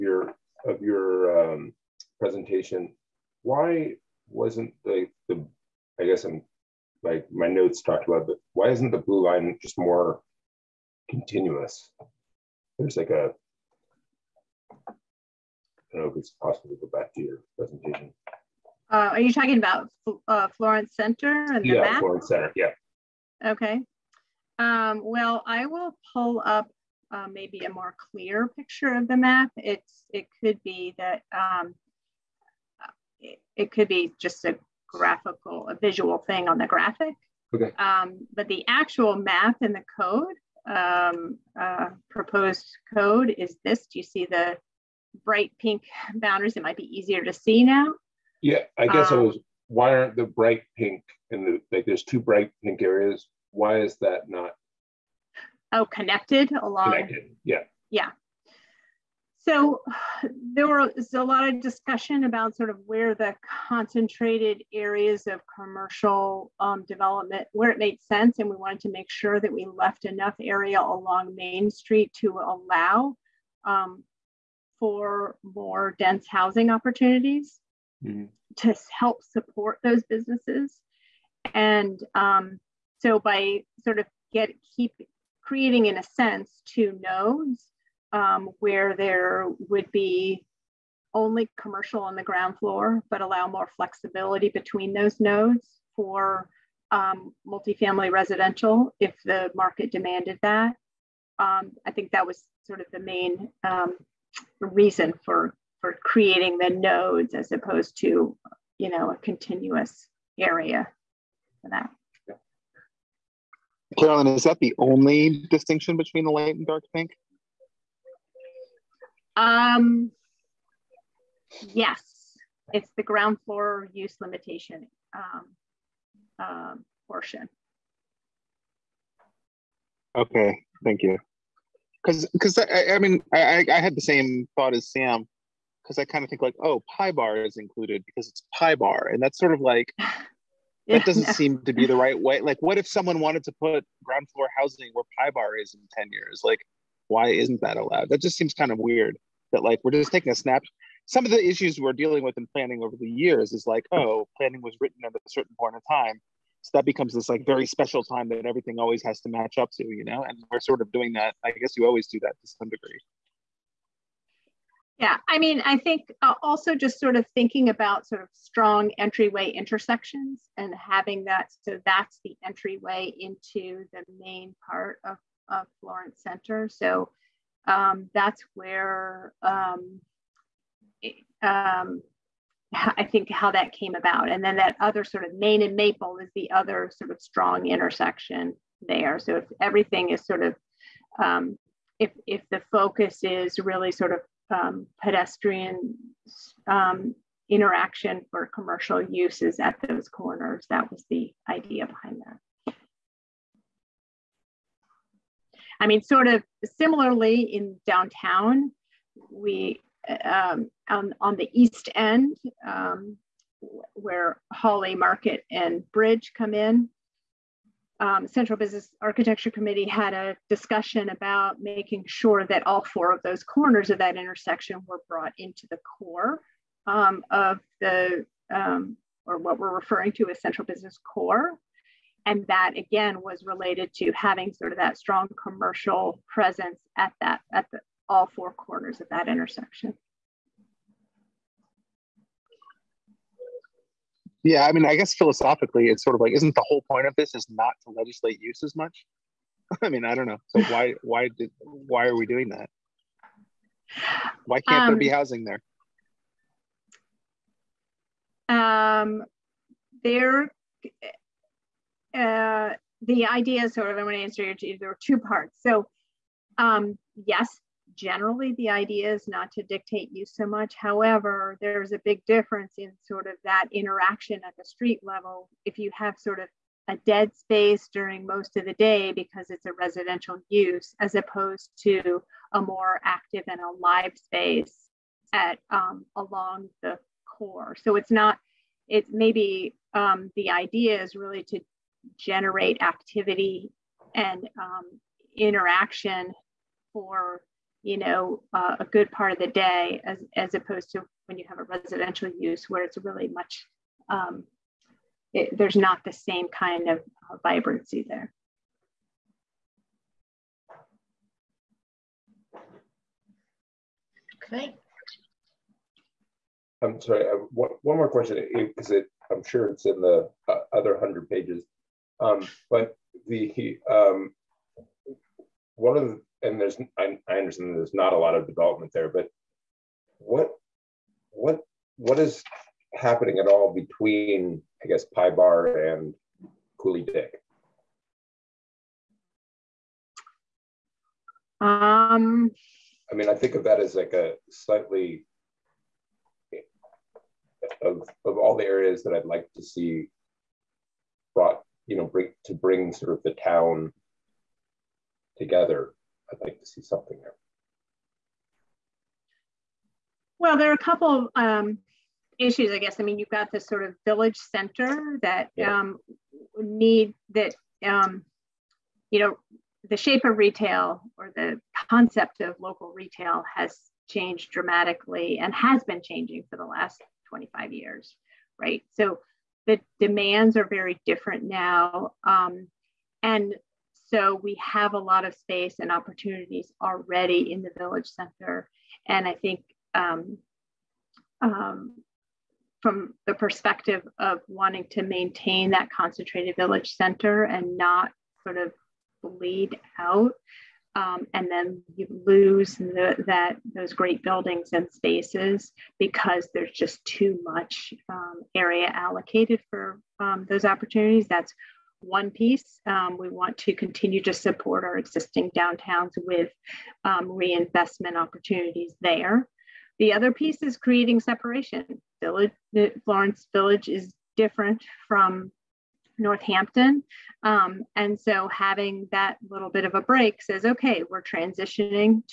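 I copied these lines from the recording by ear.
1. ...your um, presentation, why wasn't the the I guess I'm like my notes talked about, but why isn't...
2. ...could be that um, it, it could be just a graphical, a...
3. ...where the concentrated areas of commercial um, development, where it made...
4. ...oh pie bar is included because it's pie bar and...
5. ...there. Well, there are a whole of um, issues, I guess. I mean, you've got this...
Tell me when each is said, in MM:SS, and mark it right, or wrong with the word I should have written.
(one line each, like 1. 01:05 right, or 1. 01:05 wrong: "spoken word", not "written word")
1. 00:00 right
2. 00:30 right
3. 01:02 right
4. 02:16 right
5. 05:57 wrong: "couple", not "whole".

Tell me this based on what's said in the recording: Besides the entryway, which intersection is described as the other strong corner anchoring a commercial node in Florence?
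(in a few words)
Main and Maple.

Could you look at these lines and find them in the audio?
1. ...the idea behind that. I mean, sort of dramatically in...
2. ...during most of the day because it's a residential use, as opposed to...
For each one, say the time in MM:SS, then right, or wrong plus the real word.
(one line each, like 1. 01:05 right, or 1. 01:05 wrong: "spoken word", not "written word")
1. 03:21 wrong: "similarly", not "dramatically"
2. 04:37 right.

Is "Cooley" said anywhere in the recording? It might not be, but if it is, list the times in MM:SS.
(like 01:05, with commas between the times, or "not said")
05:36.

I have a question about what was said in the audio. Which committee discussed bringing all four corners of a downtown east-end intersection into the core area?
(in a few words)
Central Business Architecture Committee.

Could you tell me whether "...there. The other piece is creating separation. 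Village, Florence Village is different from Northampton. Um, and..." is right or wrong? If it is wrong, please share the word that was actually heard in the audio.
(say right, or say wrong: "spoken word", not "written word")
right.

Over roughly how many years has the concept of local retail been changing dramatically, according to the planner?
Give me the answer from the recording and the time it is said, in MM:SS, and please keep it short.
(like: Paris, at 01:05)
25 years, at 06:17.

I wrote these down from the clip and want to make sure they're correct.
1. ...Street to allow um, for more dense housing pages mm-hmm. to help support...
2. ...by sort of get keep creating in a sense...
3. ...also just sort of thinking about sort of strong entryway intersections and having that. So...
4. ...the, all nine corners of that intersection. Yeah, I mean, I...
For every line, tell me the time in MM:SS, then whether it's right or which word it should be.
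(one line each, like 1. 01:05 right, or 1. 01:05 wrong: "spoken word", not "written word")
1. 01:11 wrong: "opportunities", not "pages"
2. 01:23 right
3. 02:46 right
4. 03:57 wrong: "four", not "nine".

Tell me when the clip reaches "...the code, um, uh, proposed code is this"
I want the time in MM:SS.
00:39.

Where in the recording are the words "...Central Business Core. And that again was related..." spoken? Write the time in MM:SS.
03:50.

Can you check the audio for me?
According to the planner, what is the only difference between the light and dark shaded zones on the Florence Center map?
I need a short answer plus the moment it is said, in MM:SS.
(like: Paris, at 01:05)
Ground floor use limitation, at 02:03.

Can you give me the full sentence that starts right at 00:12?
There's like a, I don't know if it's possible to go back to your presentation.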